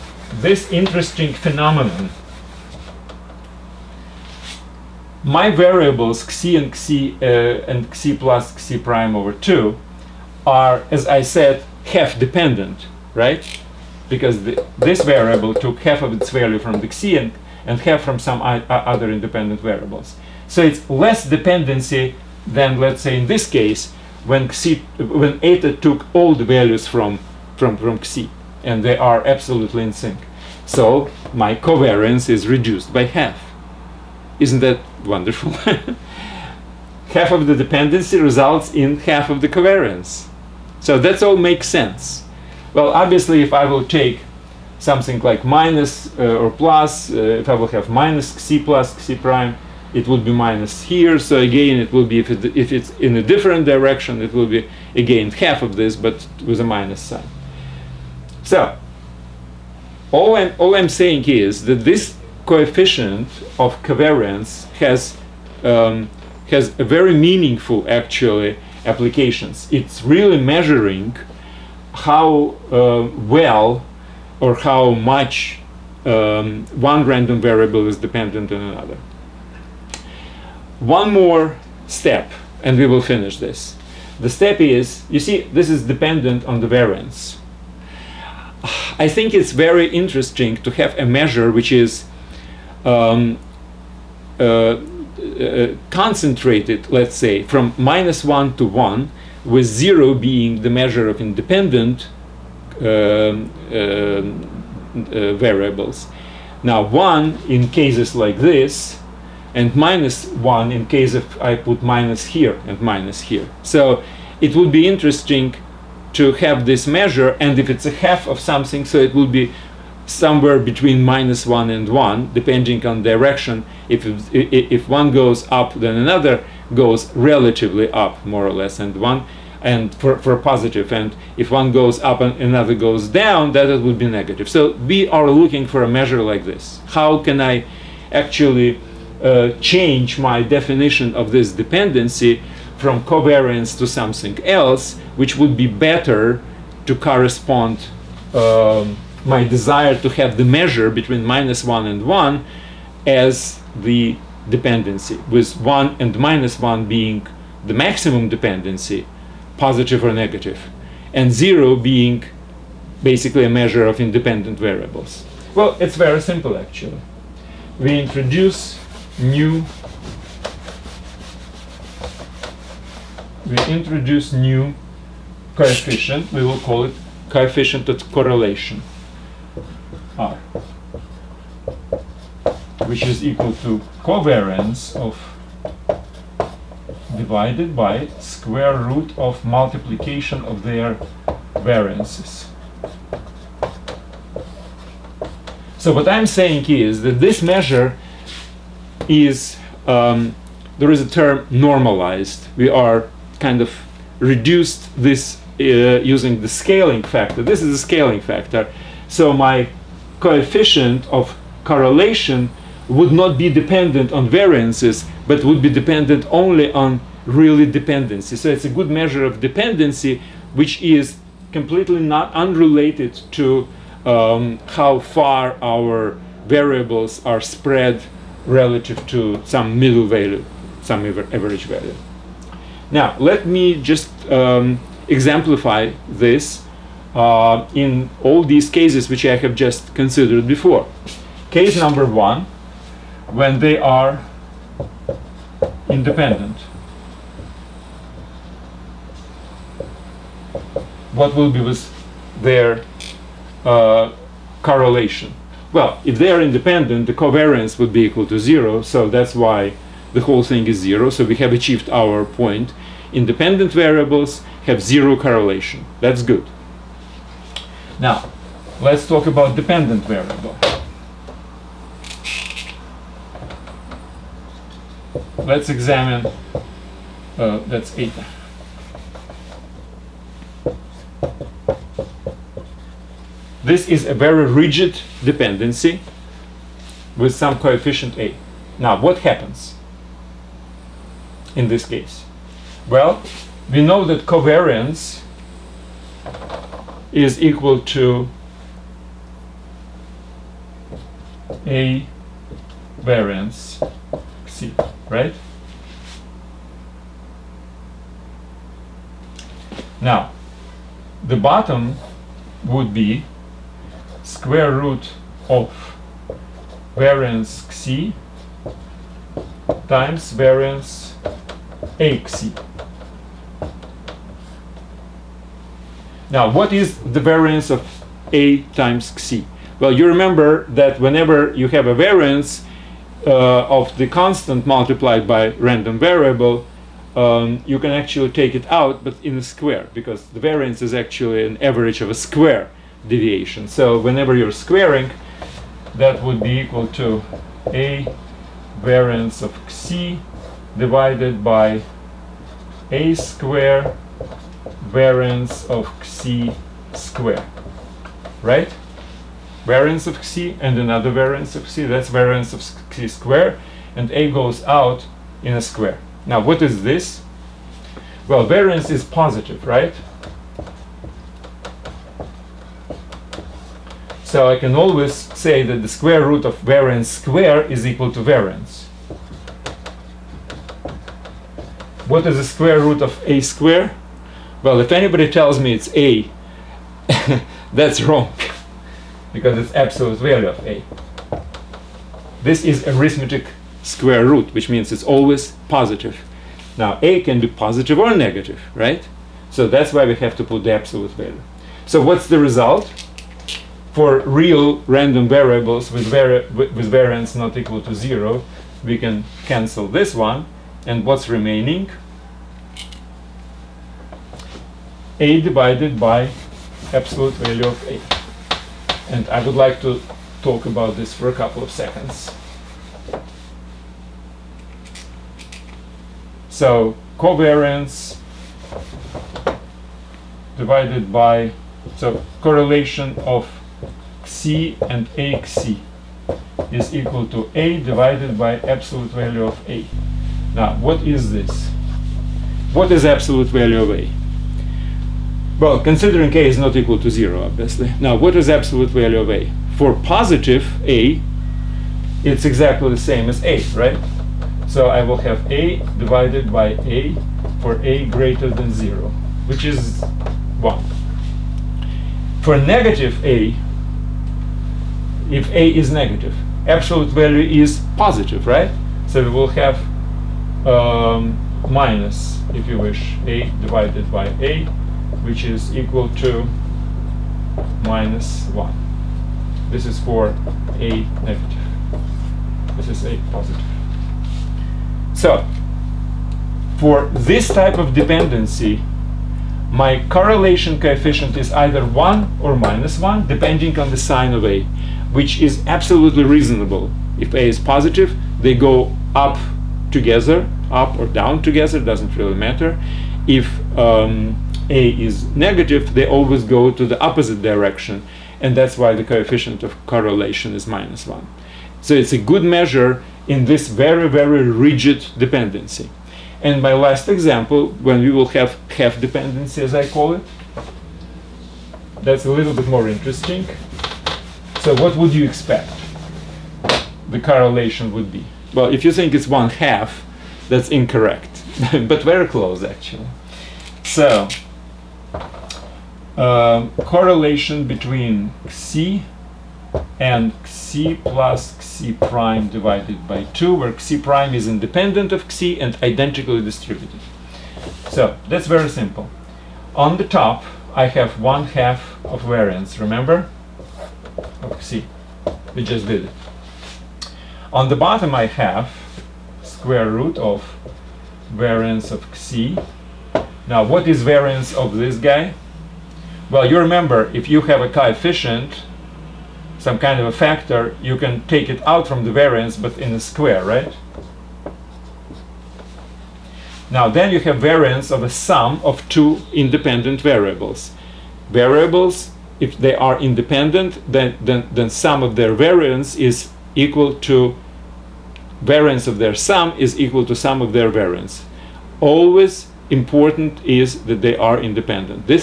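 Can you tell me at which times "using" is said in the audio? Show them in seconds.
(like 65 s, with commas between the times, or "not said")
206 s.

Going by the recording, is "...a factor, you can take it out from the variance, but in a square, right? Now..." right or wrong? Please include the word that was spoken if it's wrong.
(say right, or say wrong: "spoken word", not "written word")
right.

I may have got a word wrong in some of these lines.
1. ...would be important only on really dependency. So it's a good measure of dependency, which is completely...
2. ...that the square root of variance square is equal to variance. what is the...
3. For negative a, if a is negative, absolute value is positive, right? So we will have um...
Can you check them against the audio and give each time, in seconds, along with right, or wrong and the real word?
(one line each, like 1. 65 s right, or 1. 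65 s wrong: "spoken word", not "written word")
1. 215 s wrong: "dependent", not "important"
2. 375 s right
3. 462 s right.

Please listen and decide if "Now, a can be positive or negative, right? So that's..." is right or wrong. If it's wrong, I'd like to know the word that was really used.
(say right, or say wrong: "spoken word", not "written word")
right.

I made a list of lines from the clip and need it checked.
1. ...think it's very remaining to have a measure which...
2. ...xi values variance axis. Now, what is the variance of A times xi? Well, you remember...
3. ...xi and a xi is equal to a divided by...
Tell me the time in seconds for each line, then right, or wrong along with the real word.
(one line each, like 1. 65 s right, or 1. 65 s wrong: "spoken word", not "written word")
1. 89 s wrong: "interesting", not "remaining"
2. 317 s wrong: "times", not "values"
3. 434 s right.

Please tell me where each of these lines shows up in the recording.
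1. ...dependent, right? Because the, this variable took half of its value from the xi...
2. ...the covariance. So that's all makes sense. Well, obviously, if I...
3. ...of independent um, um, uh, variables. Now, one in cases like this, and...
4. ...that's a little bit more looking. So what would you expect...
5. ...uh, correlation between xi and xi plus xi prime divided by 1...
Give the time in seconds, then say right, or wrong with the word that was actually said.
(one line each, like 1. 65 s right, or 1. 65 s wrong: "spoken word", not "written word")
1. 12 s right
2. 39 s right
3. 101 s right
4. 522 s wrong: "interesting", not "looking"
5. 536 s wrong: "2", not "1".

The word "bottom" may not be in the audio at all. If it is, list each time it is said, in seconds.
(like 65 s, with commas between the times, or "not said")
311 s, 557 s.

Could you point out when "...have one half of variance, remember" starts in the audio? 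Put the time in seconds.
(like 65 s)
550 s.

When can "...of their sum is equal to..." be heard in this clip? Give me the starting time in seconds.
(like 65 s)
588 s.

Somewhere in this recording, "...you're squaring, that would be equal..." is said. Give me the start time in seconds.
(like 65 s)
344 s.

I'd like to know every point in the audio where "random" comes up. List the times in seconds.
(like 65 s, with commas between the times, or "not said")
77 s, 335 s, 404 s.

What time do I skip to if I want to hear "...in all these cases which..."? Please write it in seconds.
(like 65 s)
237 s.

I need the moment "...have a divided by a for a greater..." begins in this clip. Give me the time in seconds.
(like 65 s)
455 s.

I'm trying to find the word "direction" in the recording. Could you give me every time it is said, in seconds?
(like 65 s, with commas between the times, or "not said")
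53 s, 123 s, 507 s.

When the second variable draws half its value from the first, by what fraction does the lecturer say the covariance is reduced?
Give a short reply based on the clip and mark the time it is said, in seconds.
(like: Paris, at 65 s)
by half, at 32 s.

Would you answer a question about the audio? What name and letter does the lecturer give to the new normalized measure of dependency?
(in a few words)
coefficient of correlation R.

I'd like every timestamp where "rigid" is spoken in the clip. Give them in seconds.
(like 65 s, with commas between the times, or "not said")
284 s, 514 s.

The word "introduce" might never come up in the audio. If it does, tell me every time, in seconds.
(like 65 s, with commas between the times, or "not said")
167 s, 173 s.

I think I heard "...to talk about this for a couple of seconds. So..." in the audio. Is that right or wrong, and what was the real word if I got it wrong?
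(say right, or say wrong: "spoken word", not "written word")
right.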